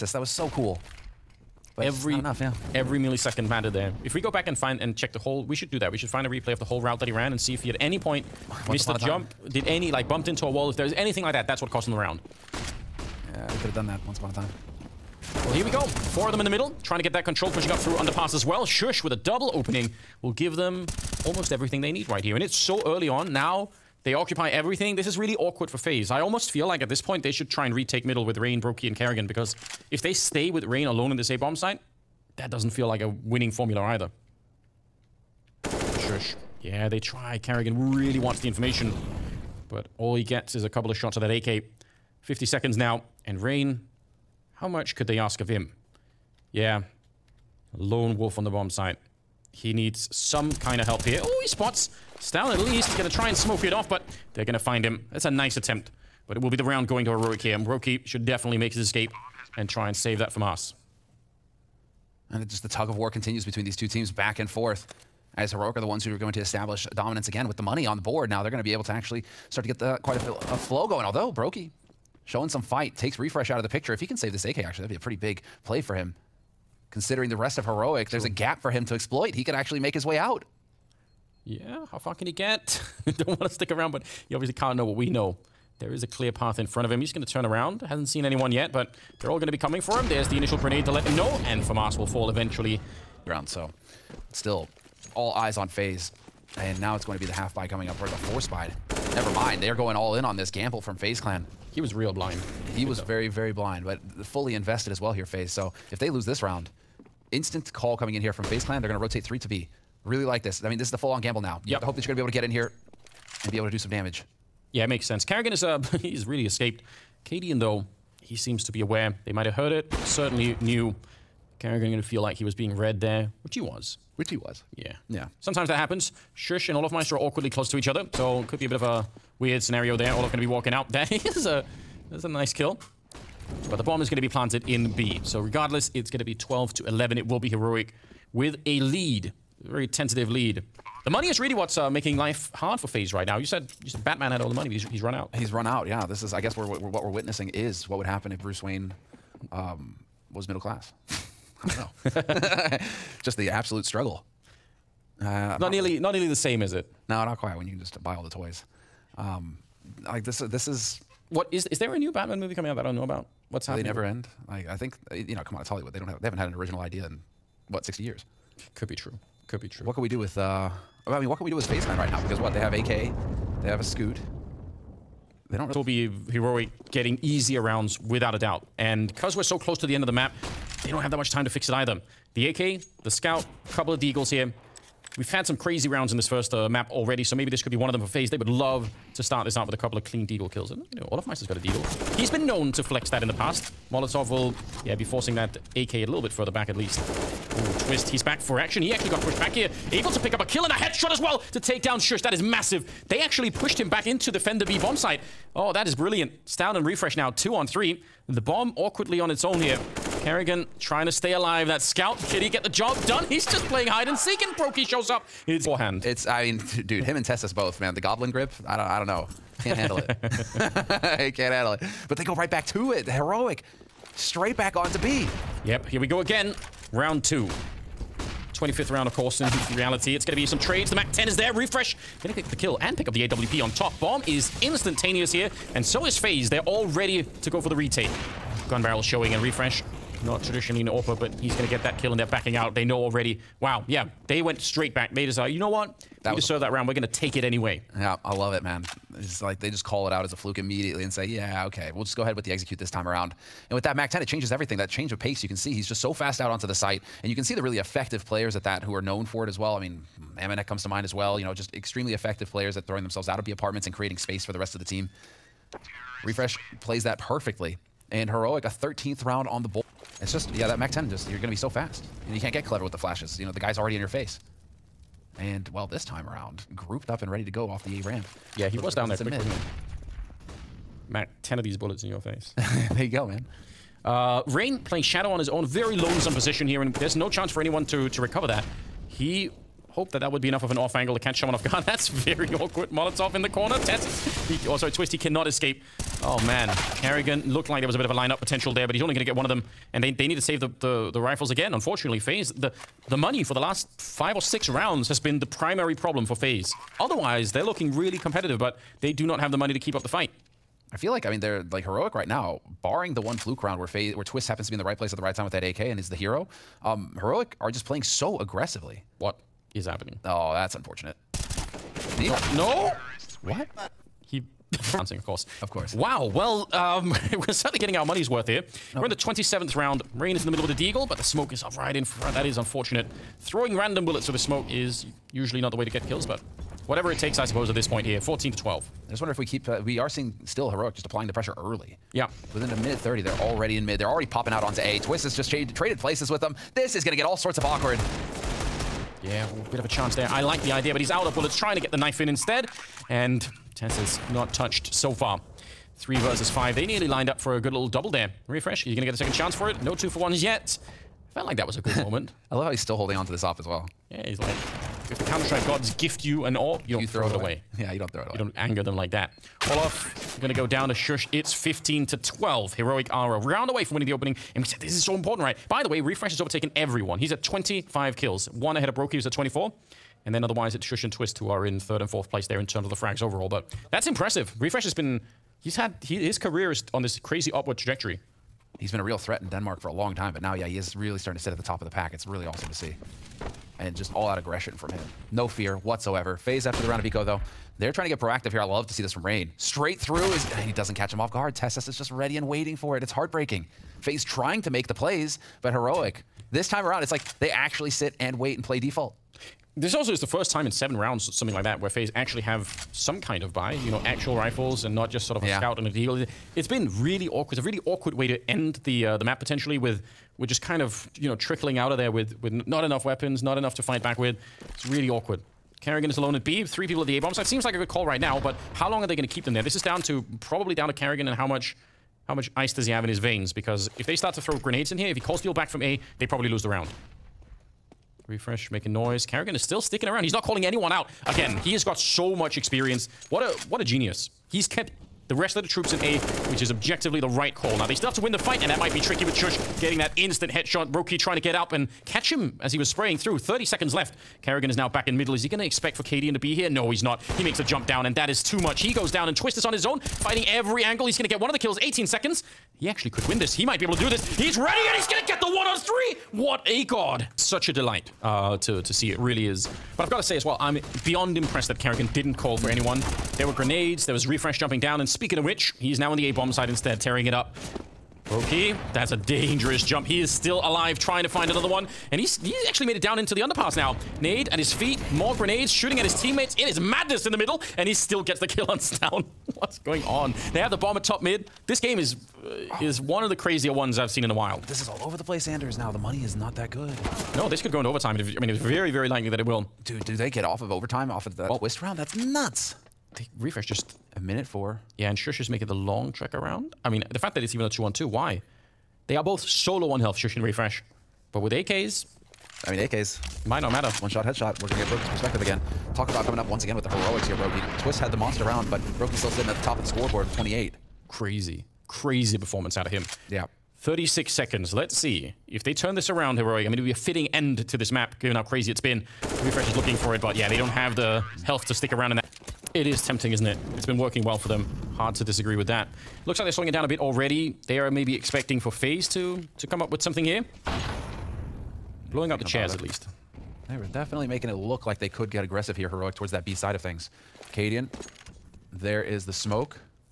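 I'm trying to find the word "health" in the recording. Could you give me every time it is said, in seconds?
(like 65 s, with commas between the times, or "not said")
509 s, 531 s.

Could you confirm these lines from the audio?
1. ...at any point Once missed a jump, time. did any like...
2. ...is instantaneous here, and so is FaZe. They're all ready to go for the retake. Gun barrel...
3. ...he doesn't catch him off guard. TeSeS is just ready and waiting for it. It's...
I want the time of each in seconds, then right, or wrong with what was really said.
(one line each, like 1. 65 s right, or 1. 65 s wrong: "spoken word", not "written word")
1. 7 s right
2. 234 s right
3. 400 s right.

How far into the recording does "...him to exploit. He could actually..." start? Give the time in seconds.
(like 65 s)
78 s.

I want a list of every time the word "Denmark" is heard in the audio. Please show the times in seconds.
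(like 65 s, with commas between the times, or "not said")
389 s.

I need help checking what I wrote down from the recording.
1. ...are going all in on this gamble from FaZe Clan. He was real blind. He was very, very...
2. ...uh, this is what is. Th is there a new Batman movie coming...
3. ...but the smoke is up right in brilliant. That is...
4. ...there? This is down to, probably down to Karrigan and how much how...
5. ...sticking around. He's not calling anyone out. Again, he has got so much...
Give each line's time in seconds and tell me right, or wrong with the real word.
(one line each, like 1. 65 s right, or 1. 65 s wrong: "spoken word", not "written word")
1. 99 s right
2. 160 s right
3. 331 s wrong: "front", not "brilliant"
4. 429 s right
5. 439 s right.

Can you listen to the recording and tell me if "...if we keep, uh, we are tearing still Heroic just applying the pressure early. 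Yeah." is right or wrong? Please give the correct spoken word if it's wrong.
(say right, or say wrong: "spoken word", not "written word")
wrong: "seeing", not "tearing".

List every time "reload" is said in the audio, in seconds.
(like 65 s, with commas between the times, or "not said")
not said.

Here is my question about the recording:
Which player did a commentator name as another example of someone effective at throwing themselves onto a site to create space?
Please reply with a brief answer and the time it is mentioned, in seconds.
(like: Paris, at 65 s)
AmaNEk, at 260 s.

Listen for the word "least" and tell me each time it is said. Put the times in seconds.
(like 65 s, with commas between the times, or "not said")
52 s, 196 s, 542 s.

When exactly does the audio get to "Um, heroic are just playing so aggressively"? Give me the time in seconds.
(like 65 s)
316 s.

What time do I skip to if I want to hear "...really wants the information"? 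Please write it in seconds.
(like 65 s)
37 s.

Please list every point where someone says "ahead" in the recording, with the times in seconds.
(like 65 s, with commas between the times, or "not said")
252 s, 378 s.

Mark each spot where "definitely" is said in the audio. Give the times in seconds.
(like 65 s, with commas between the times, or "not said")
58 s, 543 s.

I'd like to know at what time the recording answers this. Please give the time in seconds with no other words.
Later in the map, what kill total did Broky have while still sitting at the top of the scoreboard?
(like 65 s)
520 s.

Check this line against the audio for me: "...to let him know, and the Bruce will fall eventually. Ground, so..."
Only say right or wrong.
wrong.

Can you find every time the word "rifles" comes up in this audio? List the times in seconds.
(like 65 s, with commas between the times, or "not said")
301 s, 414 s.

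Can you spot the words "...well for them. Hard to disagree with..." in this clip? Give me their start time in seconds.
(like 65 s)
534 s.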